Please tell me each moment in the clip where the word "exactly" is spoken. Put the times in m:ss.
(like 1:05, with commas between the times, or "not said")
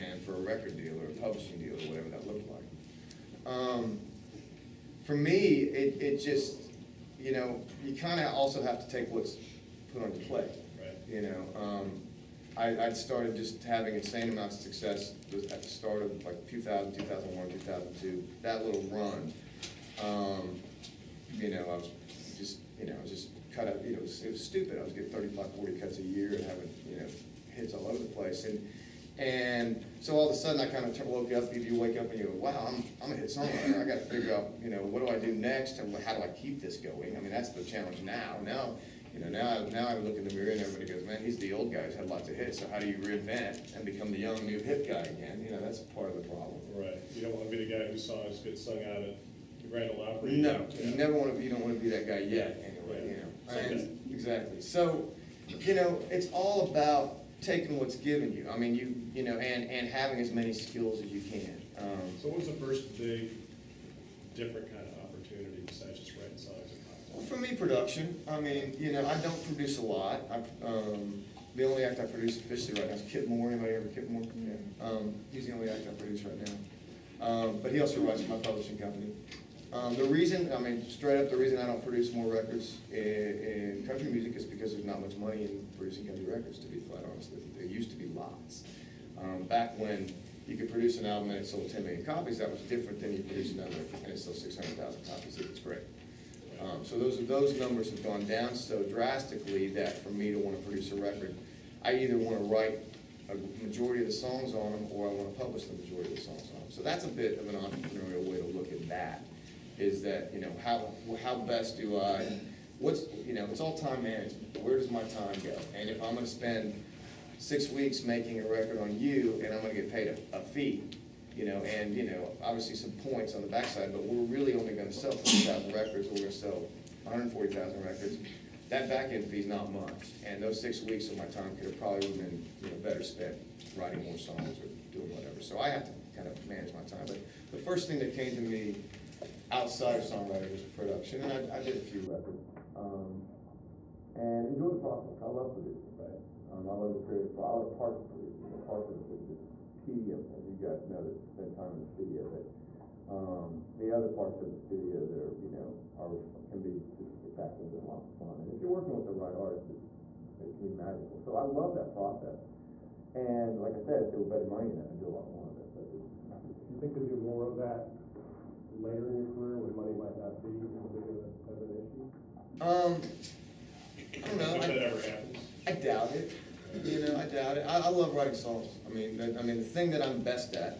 0:54.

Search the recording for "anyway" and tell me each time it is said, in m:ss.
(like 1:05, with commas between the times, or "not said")
0:52.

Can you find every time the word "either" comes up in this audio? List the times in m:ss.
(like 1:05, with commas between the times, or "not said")
1:41.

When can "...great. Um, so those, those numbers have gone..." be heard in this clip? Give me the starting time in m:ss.
1:35.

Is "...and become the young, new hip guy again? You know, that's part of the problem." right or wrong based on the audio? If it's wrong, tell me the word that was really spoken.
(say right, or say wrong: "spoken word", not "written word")
right.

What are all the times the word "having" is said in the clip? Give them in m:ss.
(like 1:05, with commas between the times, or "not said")
0:13, 0:26, 0:59.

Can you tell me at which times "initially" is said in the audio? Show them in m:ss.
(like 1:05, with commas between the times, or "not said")
not said.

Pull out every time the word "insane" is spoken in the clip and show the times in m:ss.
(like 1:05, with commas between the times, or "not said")
0:13.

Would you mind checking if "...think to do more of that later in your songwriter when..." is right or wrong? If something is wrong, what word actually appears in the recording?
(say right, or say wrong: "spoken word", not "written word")
wrong: "career", not "songwriter".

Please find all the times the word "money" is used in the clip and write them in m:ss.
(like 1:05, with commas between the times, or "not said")
1:25, 2:44, 2:49.